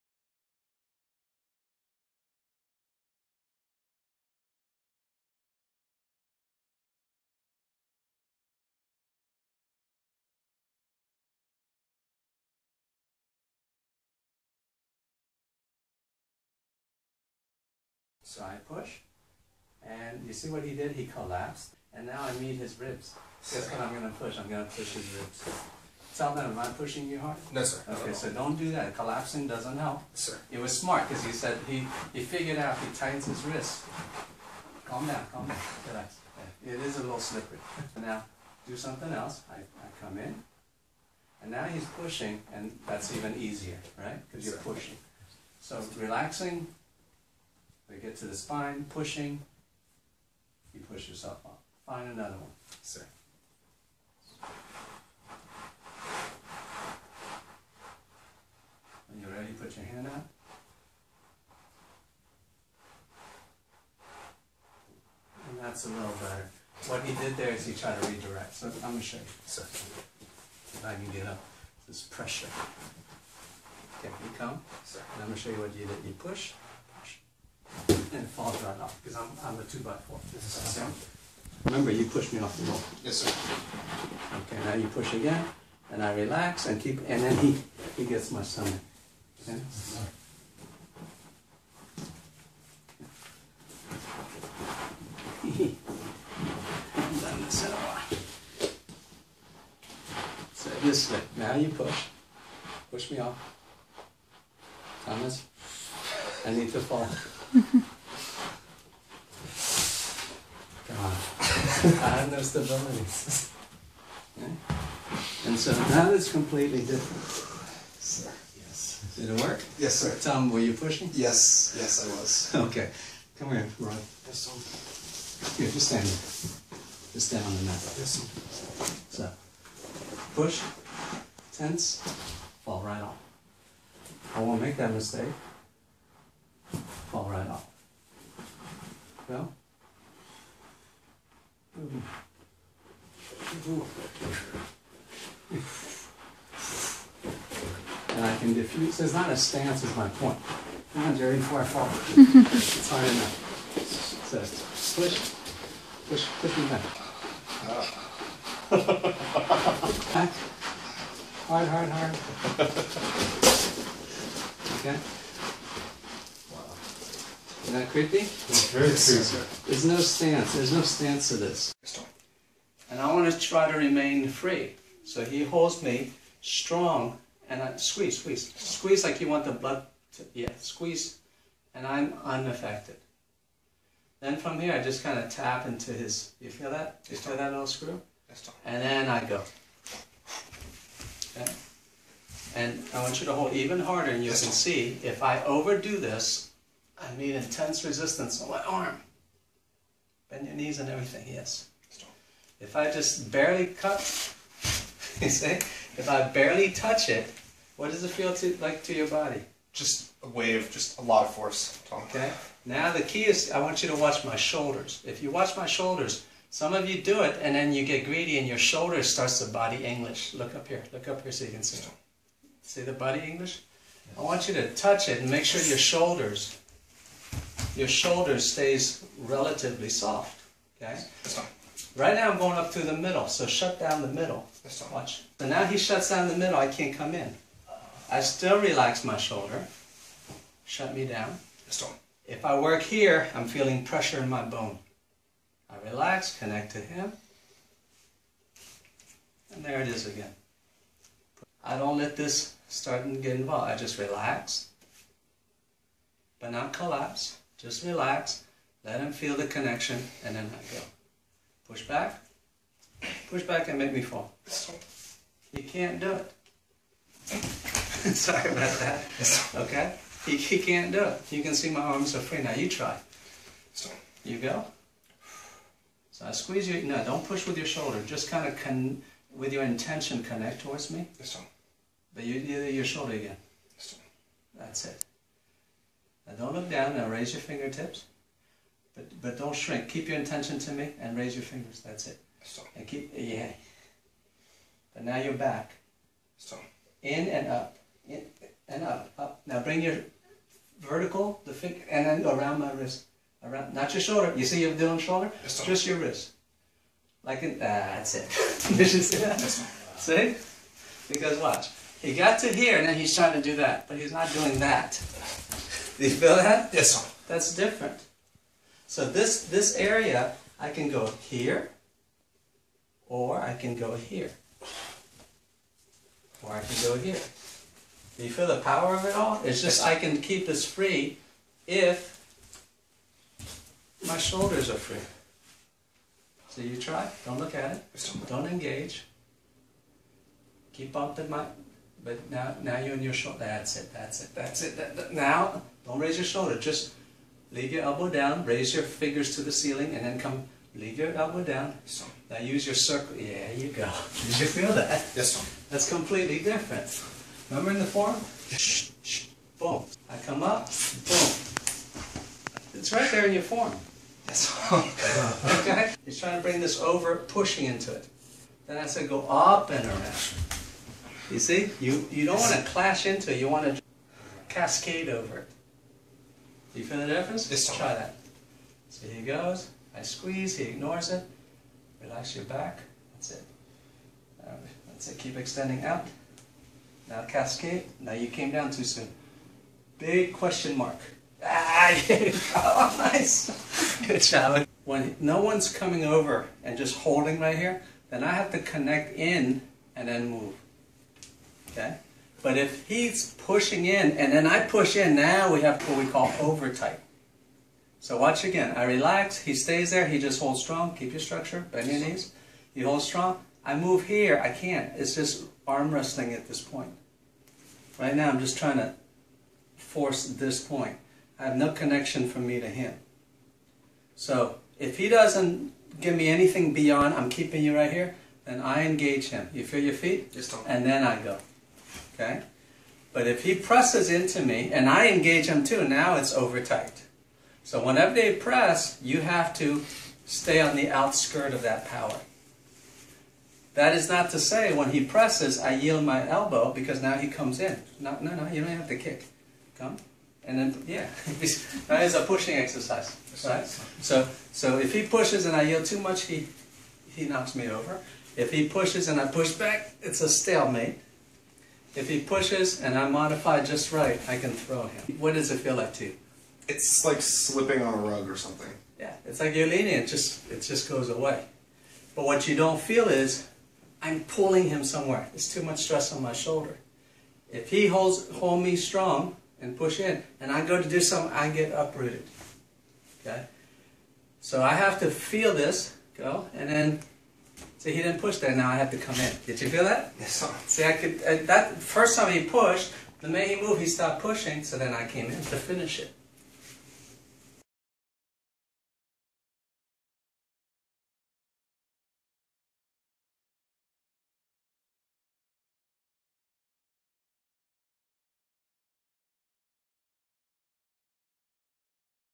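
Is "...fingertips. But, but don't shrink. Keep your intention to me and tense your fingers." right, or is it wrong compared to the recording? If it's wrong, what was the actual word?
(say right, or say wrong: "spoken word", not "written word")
wrong: "raise", not "tense".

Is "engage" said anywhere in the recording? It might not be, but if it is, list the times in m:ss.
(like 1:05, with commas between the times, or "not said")
5:38, 7:08, 7:15.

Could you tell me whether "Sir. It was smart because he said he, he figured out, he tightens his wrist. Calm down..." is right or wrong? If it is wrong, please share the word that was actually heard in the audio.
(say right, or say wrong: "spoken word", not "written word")
right.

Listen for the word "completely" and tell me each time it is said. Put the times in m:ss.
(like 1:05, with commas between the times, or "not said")
1:56, 5:55.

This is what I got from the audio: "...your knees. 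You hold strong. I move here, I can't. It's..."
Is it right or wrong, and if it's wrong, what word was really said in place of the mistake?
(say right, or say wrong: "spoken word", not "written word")
right.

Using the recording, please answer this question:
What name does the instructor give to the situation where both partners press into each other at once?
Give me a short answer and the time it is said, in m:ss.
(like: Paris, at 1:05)
Over-tight, at 6:46.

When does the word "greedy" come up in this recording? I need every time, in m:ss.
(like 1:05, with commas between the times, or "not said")
3:38.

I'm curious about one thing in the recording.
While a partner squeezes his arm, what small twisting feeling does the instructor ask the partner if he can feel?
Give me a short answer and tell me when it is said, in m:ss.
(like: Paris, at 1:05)
Little screw, at 3:07.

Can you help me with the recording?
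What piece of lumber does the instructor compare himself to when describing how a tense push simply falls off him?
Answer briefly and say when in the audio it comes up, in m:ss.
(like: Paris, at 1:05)
A two by four, at 1:19.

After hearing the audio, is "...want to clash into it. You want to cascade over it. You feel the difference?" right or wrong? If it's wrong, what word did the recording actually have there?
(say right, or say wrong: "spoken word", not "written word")
right.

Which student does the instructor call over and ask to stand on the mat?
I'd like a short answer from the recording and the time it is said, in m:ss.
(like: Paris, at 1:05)
Roy, at 2:03.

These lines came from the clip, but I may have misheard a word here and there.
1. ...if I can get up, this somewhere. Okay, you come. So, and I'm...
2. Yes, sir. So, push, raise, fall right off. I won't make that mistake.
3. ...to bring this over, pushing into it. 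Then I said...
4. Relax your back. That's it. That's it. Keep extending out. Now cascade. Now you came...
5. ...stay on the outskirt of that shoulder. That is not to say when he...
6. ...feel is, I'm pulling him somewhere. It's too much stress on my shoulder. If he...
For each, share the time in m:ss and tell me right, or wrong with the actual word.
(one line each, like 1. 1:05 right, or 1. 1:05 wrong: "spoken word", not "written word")
1. 1:09 wrong: "pressure", not "somewhere"
2. 2:07 wrong: "tense", not "raise"
3. 6:06 right
4. 6:22 right
5. 7:20 wrong: "power", not "shoulder"
6. 7:52 right.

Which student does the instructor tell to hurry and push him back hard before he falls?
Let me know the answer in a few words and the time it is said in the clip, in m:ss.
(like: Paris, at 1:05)
Jerry, at 2:31.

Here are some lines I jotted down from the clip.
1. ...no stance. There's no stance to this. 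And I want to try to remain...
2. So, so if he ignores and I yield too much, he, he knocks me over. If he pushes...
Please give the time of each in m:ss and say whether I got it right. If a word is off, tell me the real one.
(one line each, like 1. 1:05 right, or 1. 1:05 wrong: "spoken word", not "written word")
1. 2:49 right
2. 7:34 wrong: "pushes", not "ignores".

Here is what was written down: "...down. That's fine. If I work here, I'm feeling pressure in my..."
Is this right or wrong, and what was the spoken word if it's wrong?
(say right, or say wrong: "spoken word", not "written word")
right.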